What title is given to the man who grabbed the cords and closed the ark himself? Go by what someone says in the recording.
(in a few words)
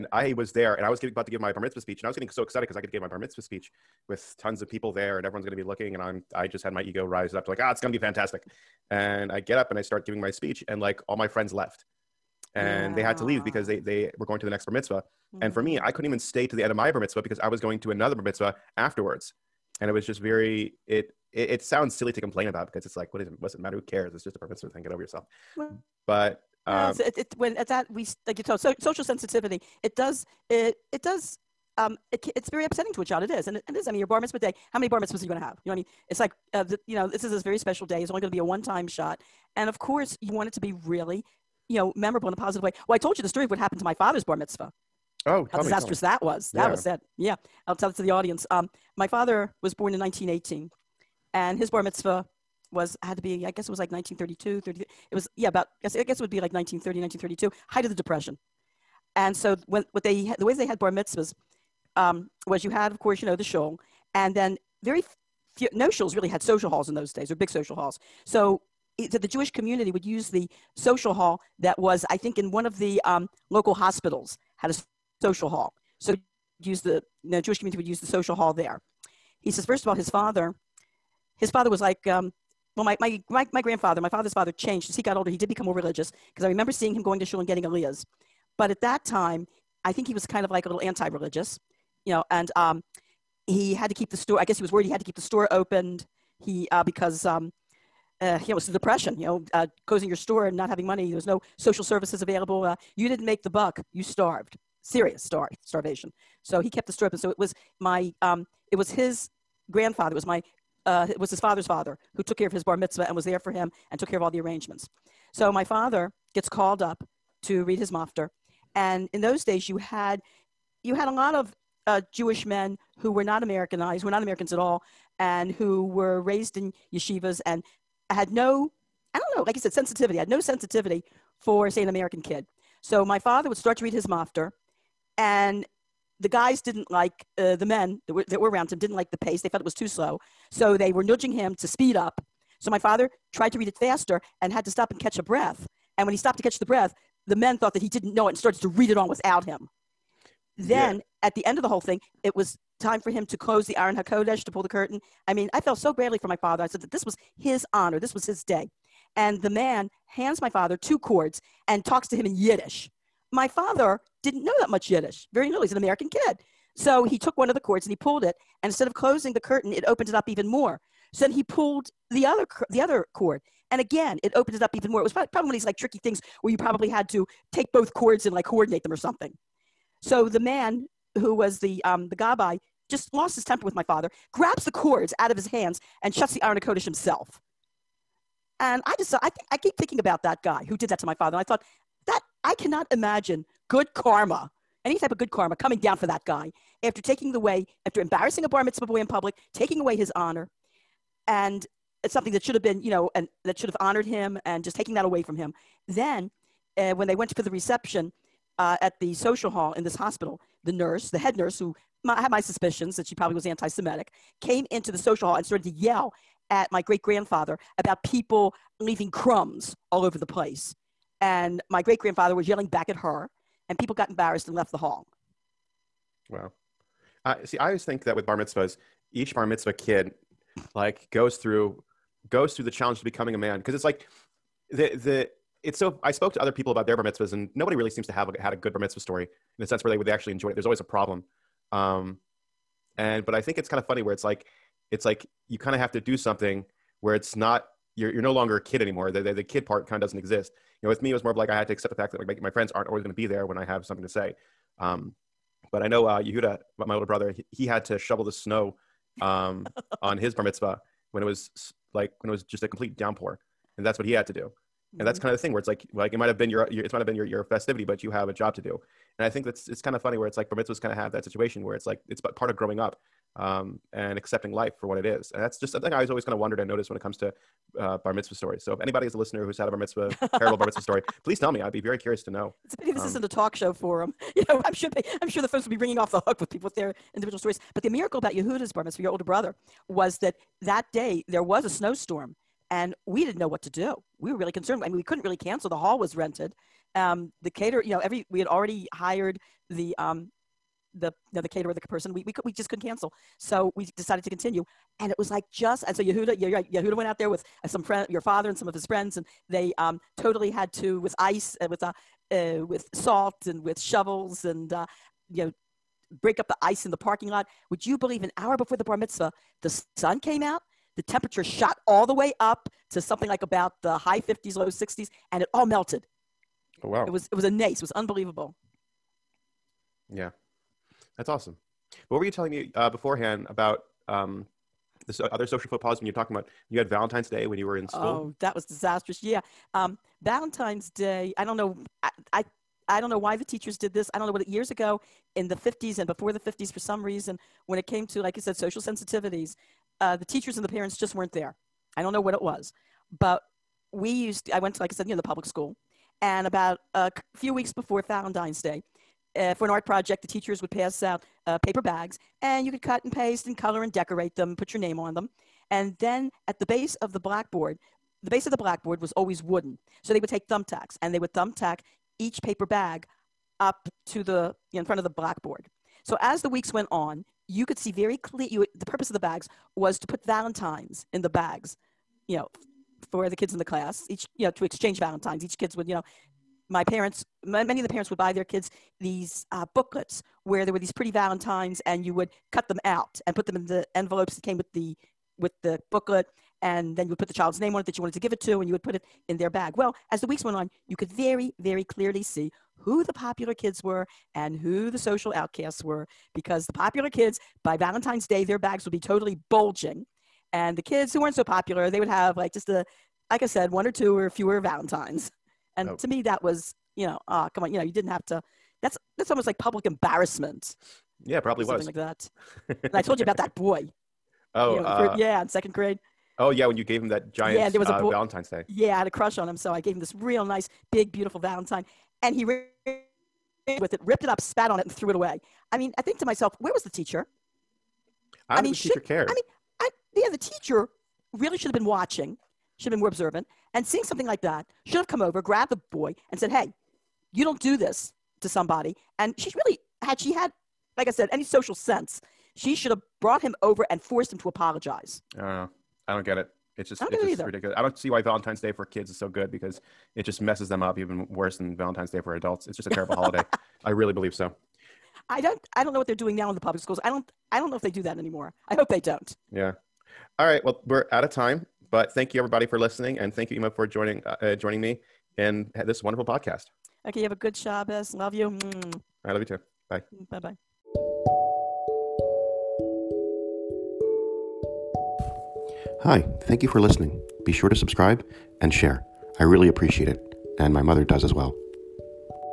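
gabbai.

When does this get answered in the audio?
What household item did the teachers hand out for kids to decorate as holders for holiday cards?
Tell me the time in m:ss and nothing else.
6:01.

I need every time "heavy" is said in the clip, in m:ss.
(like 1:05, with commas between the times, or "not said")
not said.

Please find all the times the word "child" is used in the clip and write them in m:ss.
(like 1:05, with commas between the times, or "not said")
0:33, 6:37.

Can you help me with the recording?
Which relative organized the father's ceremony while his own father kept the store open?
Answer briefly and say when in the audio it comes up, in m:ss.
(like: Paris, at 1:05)
his grandfather, at 1:48.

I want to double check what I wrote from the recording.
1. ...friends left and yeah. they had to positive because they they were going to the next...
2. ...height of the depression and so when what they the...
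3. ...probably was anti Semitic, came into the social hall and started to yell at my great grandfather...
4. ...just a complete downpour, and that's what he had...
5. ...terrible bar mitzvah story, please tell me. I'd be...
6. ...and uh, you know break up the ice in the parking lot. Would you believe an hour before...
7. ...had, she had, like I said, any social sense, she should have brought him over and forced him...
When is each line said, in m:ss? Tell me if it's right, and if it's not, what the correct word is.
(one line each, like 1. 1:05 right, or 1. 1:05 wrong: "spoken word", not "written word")
1. 0:11 wrong: "leave", not "positive"
2. 0:57 right
3. 3:33 right
4. 4:22 right
5. 4:40 right
6. 5:14 right
7. 7:30 right.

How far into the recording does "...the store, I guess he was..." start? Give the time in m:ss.
1:34.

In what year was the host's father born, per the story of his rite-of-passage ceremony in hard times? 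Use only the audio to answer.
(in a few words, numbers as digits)
1918.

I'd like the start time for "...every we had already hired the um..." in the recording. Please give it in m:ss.
4:57.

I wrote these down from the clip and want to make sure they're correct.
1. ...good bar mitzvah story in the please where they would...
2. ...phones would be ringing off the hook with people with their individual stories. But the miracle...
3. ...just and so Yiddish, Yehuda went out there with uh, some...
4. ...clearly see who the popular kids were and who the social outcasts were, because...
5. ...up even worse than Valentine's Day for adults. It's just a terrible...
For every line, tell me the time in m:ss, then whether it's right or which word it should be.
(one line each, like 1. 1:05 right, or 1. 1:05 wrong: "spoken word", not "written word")
1. 3:58 wrong: "sense", not "please"
2. 4:45 right
3. 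5:05 wrong: "Yehuda", not "Yiddish"
4. 6:41 right
5. 7:40 right.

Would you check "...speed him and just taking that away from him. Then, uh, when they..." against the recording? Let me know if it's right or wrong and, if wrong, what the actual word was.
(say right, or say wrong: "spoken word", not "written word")
wrong: "honored", not "speed".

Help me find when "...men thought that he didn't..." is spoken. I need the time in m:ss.
2:27.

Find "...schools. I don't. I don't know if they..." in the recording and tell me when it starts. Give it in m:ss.
7:46.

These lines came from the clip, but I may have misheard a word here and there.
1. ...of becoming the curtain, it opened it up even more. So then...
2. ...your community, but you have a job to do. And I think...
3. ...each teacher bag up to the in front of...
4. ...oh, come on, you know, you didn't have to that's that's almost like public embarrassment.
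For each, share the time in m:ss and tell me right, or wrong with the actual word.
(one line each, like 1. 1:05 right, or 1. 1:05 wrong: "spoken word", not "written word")
1. 2:48 wrong: "closing", not "becoming"
2. 4:27 wrong: "festivity", not "community"
3. 6:12 wrong: "paper", not "teacher"
4. 6:57 right.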